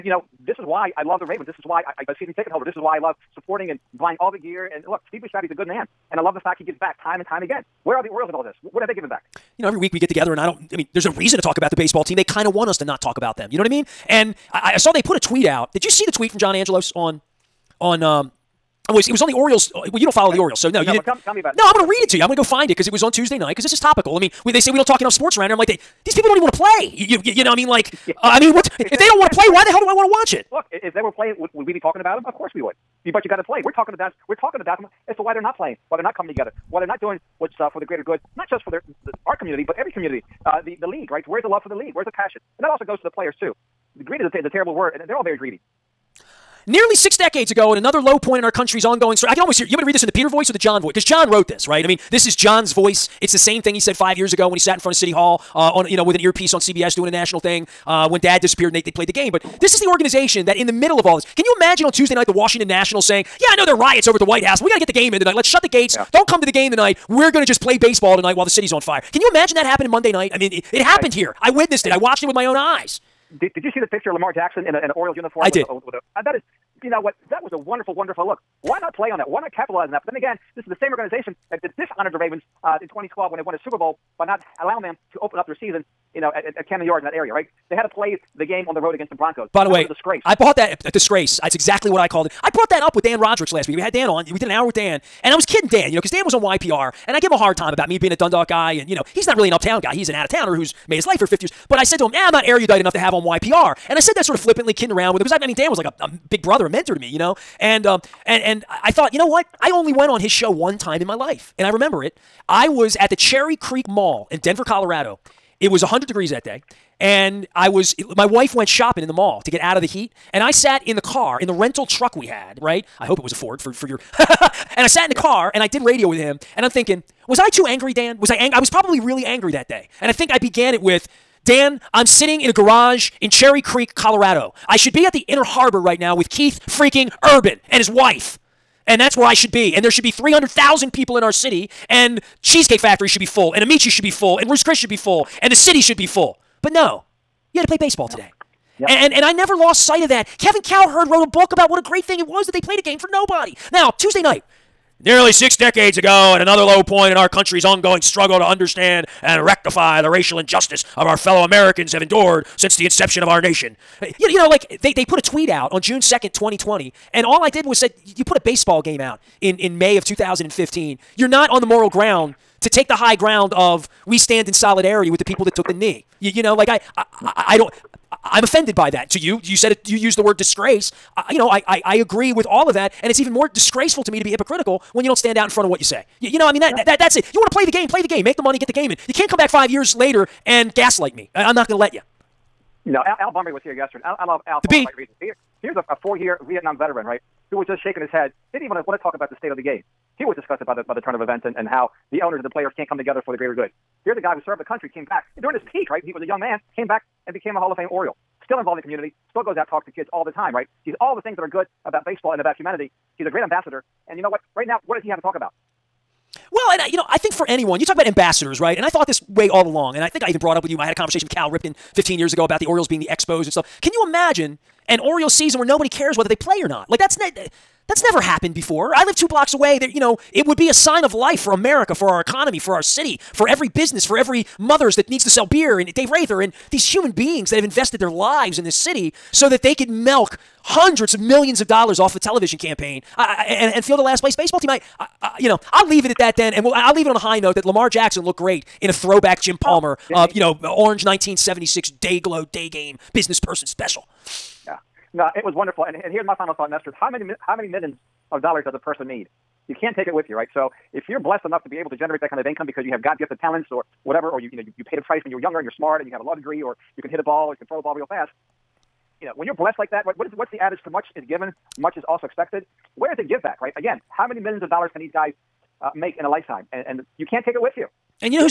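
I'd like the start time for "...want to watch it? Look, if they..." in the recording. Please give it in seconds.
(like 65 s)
29 s.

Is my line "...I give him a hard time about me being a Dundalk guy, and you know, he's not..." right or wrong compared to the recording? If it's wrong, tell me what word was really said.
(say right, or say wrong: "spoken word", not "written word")
right.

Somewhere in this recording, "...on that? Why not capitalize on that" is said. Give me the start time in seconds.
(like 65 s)
79 s.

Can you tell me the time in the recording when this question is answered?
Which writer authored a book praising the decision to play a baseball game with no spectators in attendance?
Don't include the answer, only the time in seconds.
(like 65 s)
150 s.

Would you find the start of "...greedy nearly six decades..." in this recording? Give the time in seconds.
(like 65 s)
45 s.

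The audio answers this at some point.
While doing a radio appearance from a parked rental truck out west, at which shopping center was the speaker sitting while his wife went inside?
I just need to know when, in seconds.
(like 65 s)
113 s.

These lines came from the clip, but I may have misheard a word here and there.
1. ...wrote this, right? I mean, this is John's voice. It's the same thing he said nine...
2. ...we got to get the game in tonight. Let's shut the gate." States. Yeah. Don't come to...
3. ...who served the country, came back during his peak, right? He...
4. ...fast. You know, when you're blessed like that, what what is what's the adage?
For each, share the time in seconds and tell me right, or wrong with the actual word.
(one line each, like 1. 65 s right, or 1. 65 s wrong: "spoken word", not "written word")
1. 51 s wrong: "five", not "nine"
2. 64 s right
3. 204 s right
4. 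268 s right.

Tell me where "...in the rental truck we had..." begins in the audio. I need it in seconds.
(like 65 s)
121 s.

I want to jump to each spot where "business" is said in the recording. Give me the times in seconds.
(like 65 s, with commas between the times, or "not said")
233 s, 253 s.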